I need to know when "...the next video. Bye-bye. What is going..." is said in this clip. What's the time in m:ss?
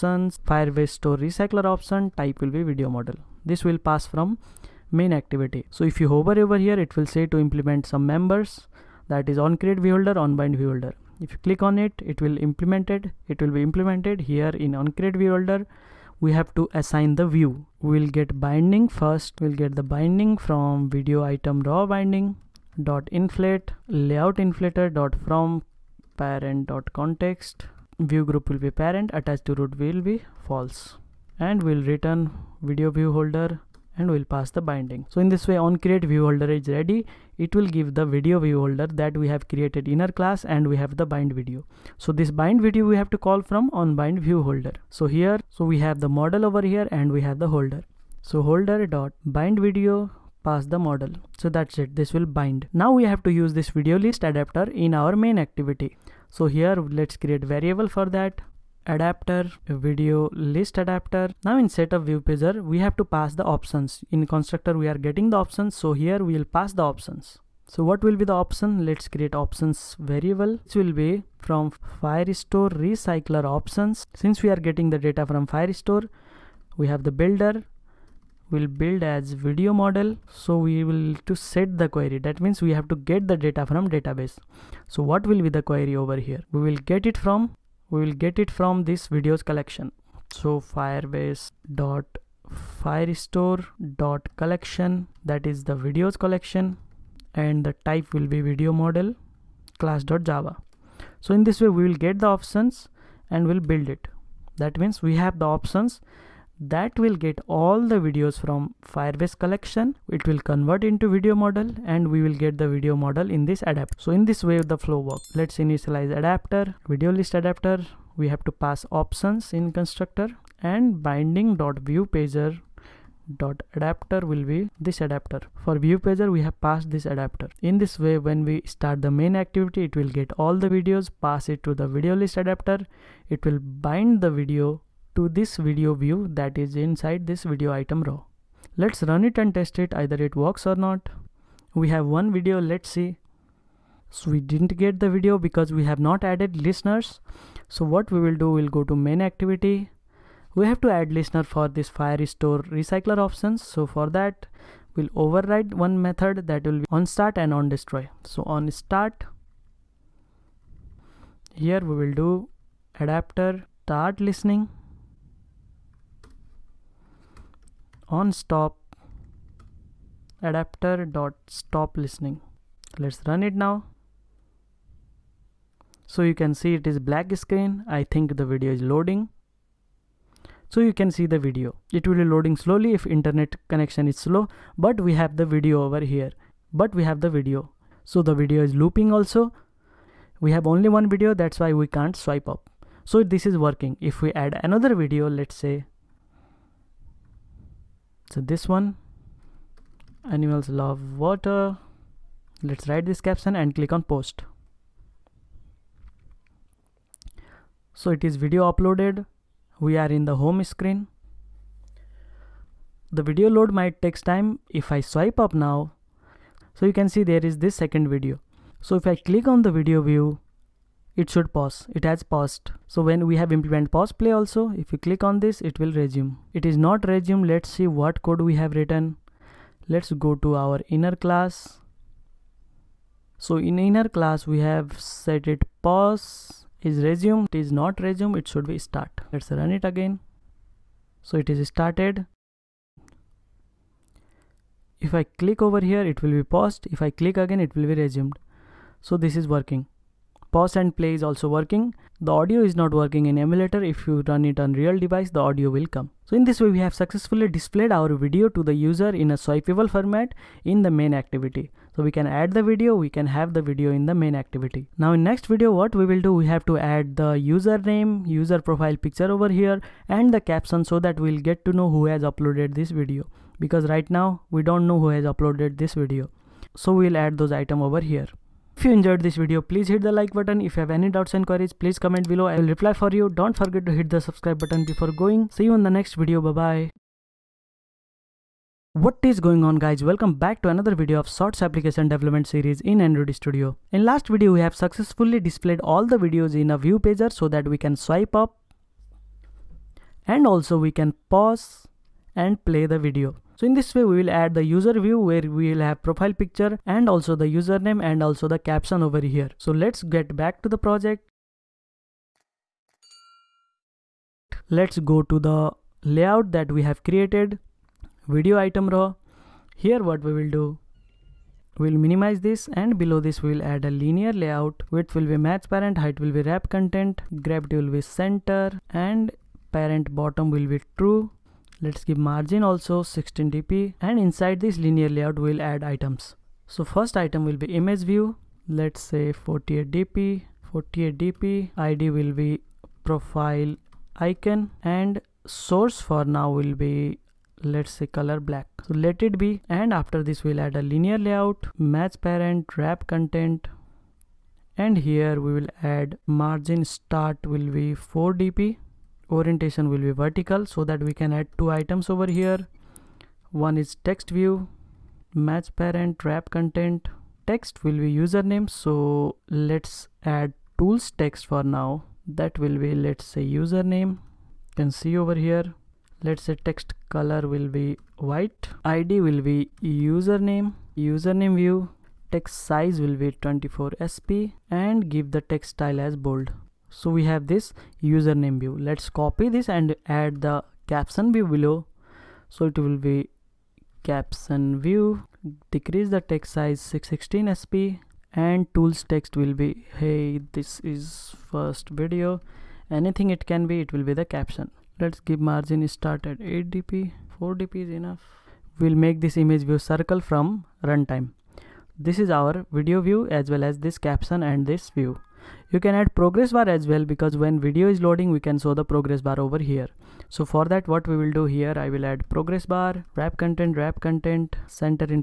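4:45.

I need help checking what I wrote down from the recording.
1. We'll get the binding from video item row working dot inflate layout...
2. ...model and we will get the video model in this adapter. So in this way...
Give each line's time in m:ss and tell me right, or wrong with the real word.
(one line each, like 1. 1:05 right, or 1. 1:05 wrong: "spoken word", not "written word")
1. 0:19 wrong: "binding", not "working"
2. 1:51 right.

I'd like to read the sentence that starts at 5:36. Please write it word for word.
So first item will be image view.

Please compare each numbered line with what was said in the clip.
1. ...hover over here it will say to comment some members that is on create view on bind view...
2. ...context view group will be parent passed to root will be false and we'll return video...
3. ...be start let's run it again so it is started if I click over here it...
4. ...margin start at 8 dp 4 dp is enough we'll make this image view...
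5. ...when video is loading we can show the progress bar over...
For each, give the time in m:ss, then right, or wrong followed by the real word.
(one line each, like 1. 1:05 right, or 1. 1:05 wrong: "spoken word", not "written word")
1. 0:06 wrong: "implement", not "comment"
2. 0:26 wrong: "attached", not "passed"
3. 3:58 right
4. 6:45 right
5. 6:57 right.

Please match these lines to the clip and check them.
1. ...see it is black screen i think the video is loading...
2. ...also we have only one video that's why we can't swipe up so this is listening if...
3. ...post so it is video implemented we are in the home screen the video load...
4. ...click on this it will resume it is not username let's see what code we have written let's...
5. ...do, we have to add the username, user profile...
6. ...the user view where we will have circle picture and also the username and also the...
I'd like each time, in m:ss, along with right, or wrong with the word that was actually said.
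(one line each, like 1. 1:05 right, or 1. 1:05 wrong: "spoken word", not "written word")
1. 2:56 right
2. 3:09 wrong: "working", not "listening"
3. 3:24 wrong: "uploaded", not "implemented"
4. 3:45 wrong: "resume", not "username"
5. 4:26 right
6. 5:04 wrong: "profile", not "circle".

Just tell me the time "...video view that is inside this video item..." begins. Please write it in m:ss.
2:15.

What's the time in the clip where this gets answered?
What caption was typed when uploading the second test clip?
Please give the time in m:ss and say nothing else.
3:20.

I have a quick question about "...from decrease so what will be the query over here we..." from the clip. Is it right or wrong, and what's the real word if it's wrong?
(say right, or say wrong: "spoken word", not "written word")
wrong: "database", not "decrease".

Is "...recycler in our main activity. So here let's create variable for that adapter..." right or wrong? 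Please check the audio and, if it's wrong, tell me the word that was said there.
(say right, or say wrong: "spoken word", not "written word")
wrong: "adapter", not "recycler".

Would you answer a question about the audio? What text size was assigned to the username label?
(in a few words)
24 sp.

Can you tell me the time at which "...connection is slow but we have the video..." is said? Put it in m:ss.
3:03.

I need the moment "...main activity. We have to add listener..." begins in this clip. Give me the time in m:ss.
2:28.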